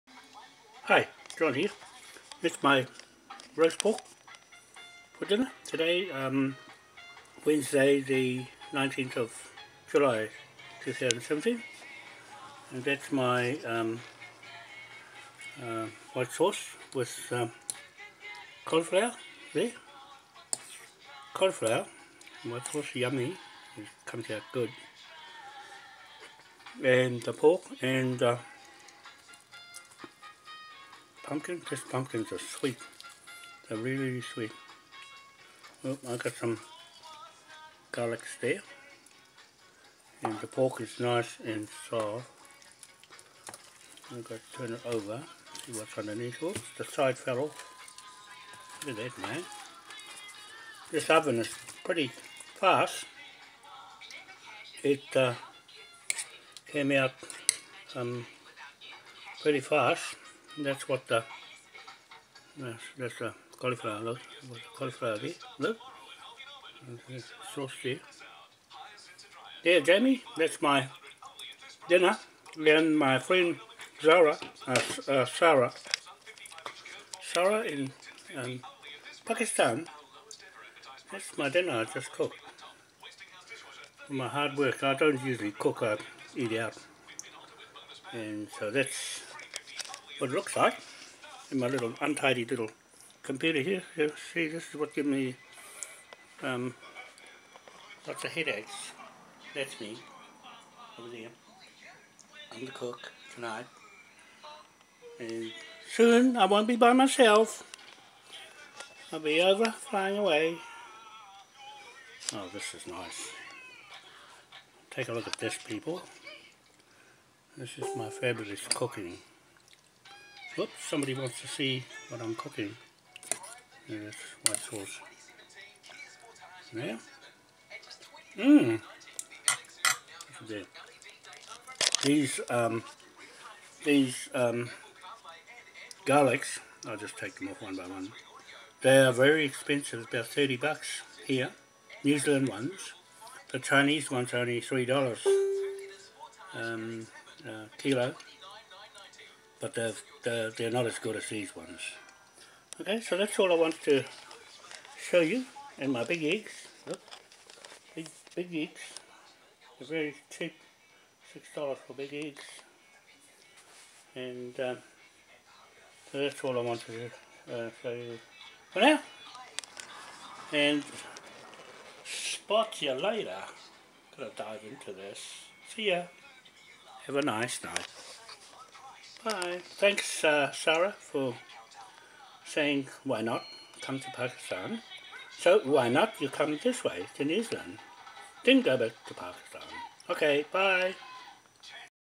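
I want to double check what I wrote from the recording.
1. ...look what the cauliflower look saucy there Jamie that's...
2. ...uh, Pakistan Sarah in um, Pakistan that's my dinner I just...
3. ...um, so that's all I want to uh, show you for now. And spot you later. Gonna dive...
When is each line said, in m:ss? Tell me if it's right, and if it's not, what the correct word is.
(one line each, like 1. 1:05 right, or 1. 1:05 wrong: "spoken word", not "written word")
1. 1:04 right
2. 1:15 wrong: "Sarah", not "Pakistan"
3. 2:44 right.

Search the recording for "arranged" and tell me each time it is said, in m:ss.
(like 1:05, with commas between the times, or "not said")
not said.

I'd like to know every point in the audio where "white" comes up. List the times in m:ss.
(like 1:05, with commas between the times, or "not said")
0:16, 0:22, 2:04.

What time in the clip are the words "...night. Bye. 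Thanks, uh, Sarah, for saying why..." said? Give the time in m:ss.
2:57.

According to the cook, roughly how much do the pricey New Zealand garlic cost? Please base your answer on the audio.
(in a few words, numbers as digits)
$30.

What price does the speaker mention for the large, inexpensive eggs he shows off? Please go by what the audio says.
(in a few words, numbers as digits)
$6.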